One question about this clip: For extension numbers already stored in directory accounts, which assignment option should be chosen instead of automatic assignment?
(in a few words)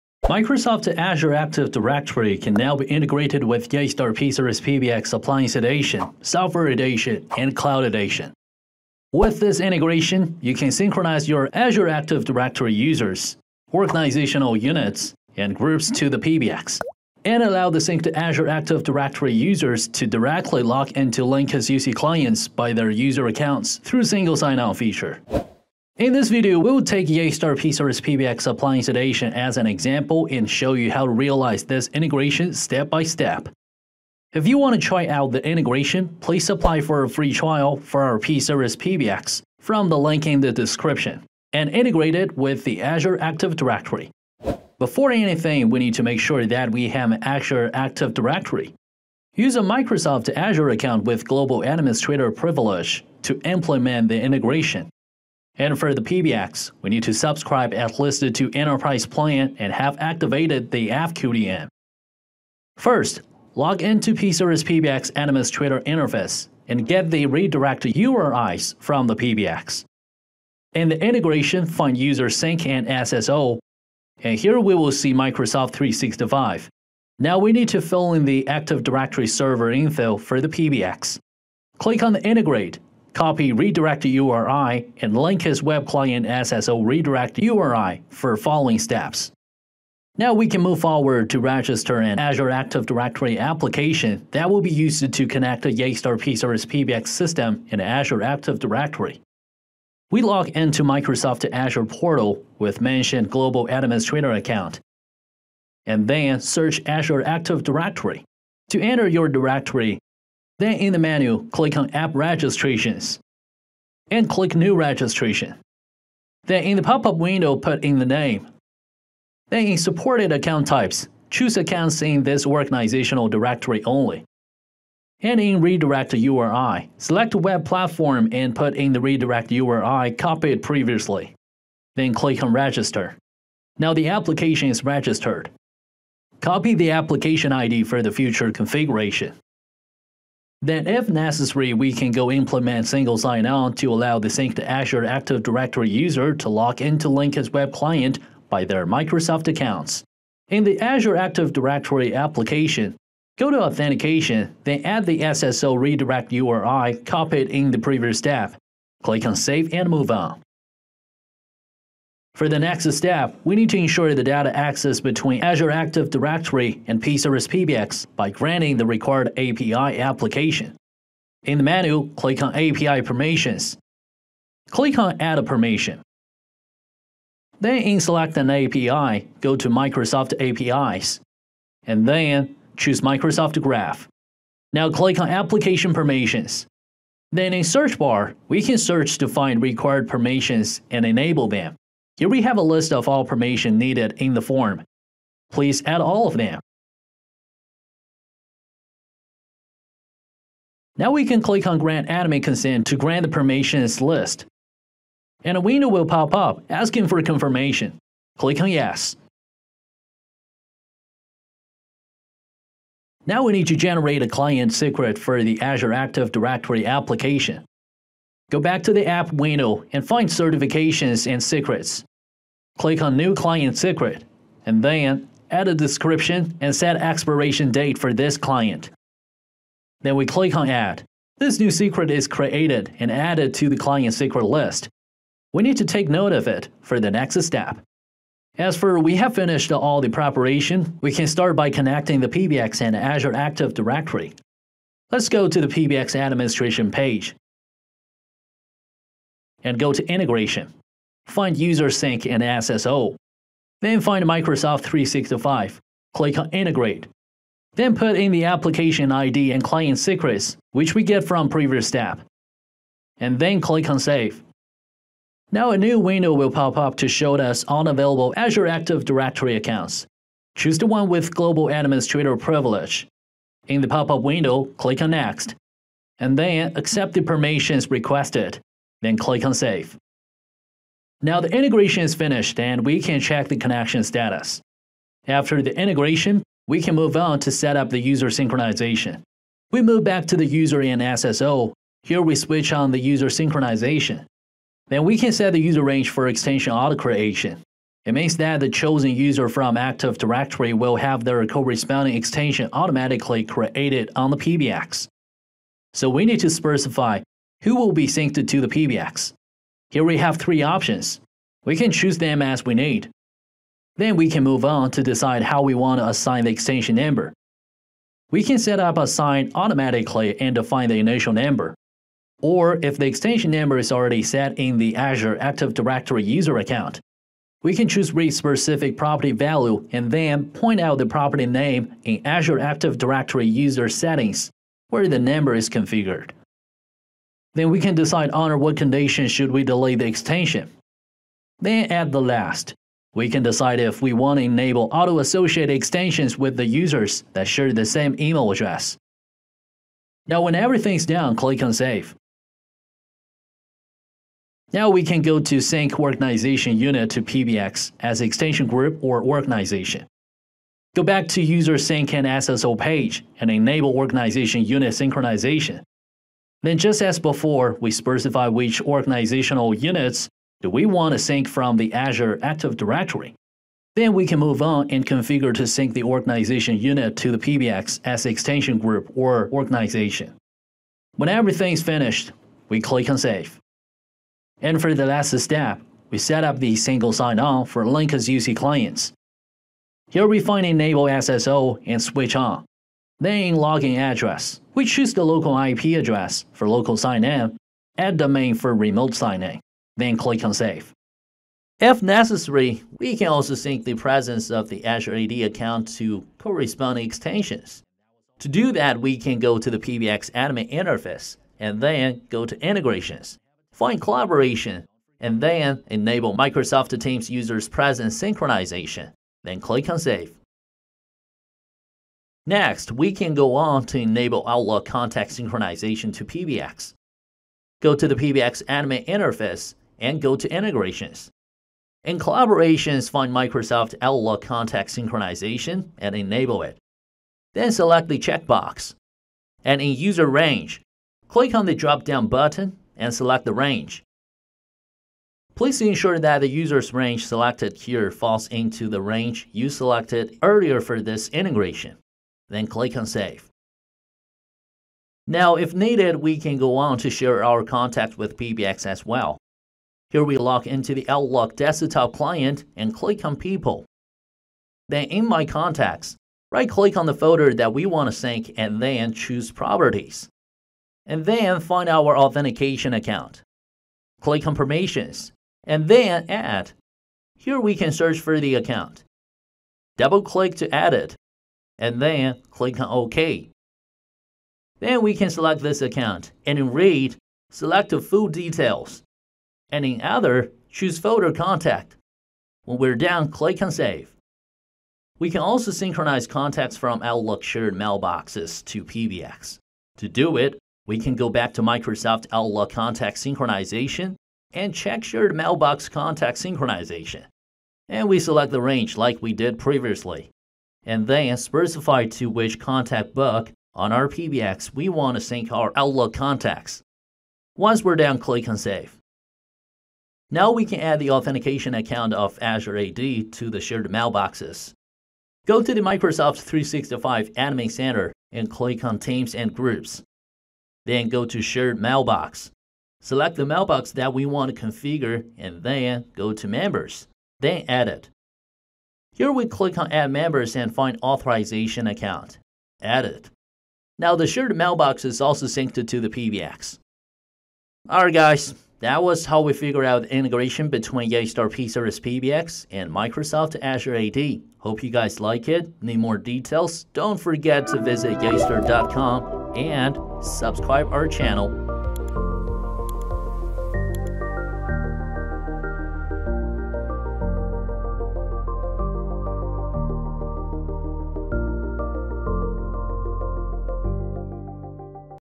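read specific property value.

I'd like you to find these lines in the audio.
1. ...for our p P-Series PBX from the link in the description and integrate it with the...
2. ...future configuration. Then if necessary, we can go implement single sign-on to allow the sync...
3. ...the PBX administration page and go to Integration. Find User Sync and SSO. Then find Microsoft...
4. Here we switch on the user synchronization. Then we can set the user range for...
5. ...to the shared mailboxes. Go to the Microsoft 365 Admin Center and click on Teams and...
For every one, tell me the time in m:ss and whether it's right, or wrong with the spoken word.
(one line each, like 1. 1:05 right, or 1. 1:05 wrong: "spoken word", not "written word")
1. 0:37 right
2. 2:18 right
3. 4:05 right
4. 4:52 right
5. 8:42 right.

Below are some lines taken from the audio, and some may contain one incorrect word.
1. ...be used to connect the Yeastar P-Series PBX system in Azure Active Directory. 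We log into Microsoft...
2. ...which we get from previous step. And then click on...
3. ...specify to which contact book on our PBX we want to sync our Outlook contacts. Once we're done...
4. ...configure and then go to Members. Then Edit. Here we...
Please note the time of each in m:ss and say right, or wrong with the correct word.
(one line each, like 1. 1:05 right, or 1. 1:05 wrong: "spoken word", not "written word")
1. 1:34 right
2. 4:20 right
3. 8:31 right
4. 8:54 right.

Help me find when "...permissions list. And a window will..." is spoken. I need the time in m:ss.
3:23.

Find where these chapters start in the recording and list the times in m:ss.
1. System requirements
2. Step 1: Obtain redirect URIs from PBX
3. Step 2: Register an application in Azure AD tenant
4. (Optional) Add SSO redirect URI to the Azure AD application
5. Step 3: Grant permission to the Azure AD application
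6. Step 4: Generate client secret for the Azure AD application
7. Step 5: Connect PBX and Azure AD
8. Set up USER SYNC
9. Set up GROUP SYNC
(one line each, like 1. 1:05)
1. 0:47
2. 1:04
3. 1:33
4. 2:25
5. 2:43
6. 3:33
7. 4:00
8. 4:47
9. 5:55.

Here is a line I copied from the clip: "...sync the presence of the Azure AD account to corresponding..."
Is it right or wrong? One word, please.
right.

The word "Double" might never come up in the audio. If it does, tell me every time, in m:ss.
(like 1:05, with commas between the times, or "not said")
7:59.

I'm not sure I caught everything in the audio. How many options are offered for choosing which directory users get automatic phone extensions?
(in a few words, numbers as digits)
3.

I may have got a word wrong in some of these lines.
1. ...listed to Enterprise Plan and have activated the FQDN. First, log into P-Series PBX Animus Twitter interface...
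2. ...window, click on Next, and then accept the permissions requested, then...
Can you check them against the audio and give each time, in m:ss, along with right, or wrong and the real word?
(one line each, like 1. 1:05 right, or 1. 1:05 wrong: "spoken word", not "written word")
1. 0:57 right
2. 4:34 right.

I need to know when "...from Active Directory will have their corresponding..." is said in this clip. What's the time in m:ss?
4:59.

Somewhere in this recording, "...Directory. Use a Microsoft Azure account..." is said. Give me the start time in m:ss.
0:48.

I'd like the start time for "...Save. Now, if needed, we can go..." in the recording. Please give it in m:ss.
7:33.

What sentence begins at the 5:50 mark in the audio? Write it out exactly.
Now when everything's done, click on Save.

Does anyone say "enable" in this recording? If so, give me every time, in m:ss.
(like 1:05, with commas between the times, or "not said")
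3:11, 5:44, 6:03, 6:30, 6:55, 7:03, 7:16.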